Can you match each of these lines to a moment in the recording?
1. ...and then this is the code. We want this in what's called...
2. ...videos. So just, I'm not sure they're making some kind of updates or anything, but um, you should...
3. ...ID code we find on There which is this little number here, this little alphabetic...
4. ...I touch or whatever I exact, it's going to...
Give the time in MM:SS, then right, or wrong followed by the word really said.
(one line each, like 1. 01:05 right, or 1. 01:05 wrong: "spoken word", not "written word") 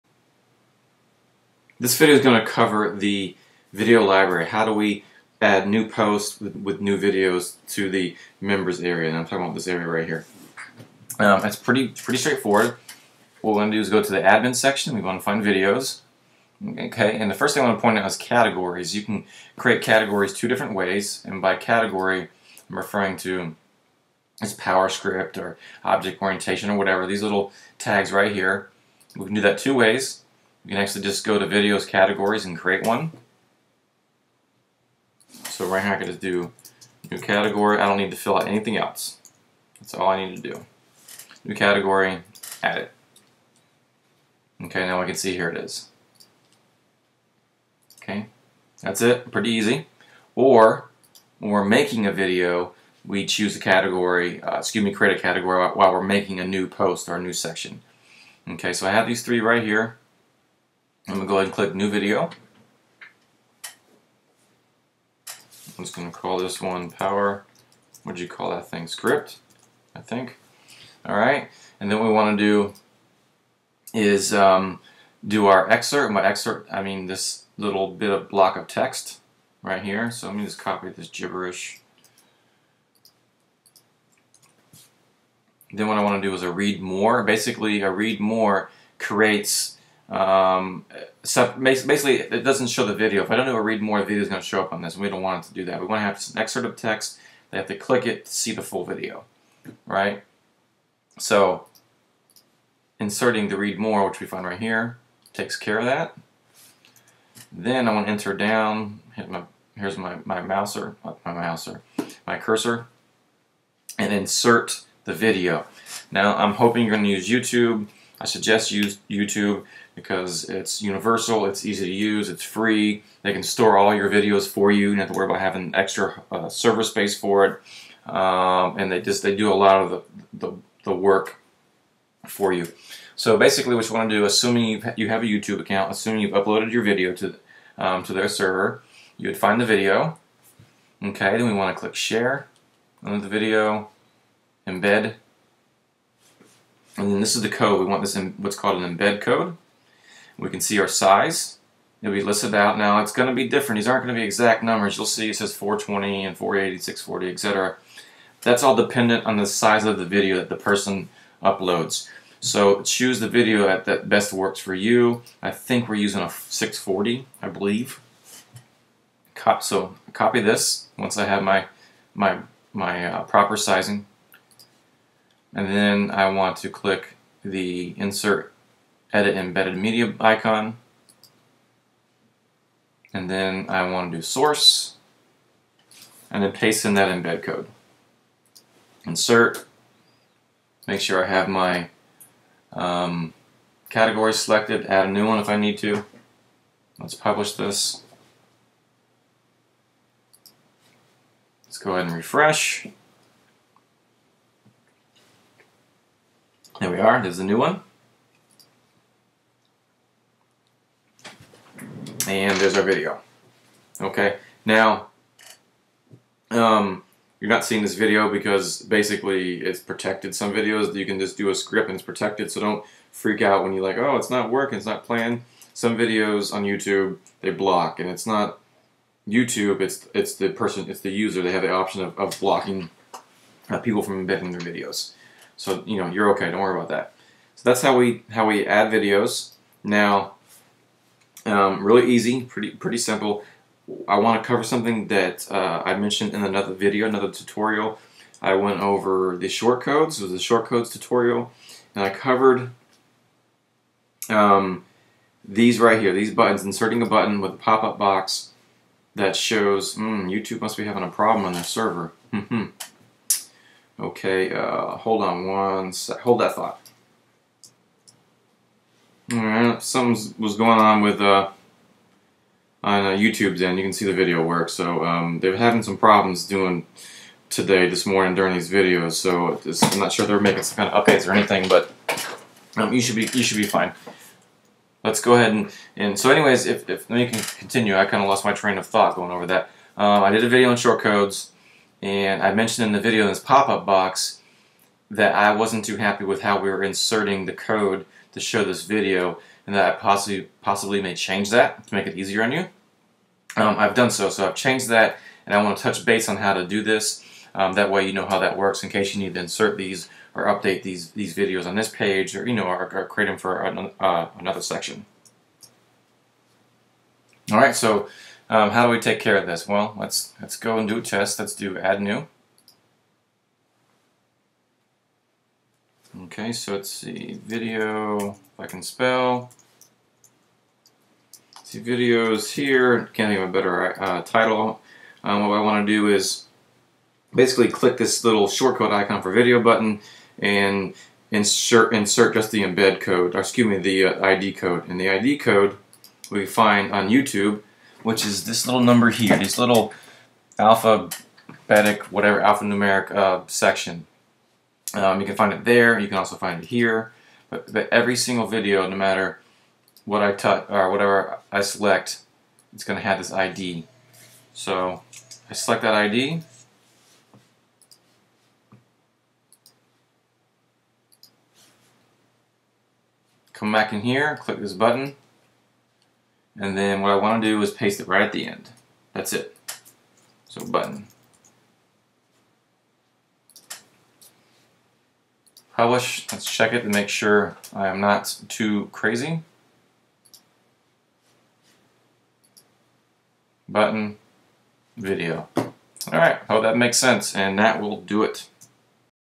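1. 02:26 right
2. 04:38 right
3. 05:45 wrong: "YouTube", not "There"
4. 06:00 wrong: "select", not "exact".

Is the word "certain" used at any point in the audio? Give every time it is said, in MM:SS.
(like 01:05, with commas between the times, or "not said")
not said.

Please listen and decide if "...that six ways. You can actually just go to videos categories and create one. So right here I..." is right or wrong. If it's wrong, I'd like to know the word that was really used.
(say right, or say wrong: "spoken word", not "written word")
wrong: "two", not "six".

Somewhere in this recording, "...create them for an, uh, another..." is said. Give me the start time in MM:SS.
05:13.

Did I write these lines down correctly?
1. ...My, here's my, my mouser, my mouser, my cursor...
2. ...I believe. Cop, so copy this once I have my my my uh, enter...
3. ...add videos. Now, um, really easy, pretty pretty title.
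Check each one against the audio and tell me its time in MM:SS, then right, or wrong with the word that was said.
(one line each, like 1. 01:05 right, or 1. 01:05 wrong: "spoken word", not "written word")
1. 01:49 right
2. 02:47 wrong: "proper", not "enter"
3. 03:58 wrong: "simple", not "title".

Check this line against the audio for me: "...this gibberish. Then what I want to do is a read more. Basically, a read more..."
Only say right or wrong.
right.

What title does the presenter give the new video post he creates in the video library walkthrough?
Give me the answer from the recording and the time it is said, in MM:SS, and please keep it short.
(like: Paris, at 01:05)
PowerScript, at 01:06.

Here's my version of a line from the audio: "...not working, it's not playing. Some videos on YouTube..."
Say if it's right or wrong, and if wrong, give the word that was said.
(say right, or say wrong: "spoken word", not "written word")
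right.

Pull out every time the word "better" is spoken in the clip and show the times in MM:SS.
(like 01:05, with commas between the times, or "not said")
05:33.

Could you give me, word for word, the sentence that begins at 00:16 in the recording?
Okay, and the first thing I want to point out is categories.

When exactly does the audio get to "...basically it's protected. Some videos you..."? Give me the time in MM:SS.
03:38.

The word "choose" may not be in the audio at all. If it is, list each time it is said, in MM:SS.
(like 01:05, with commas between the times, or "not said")
00:53, 02:42.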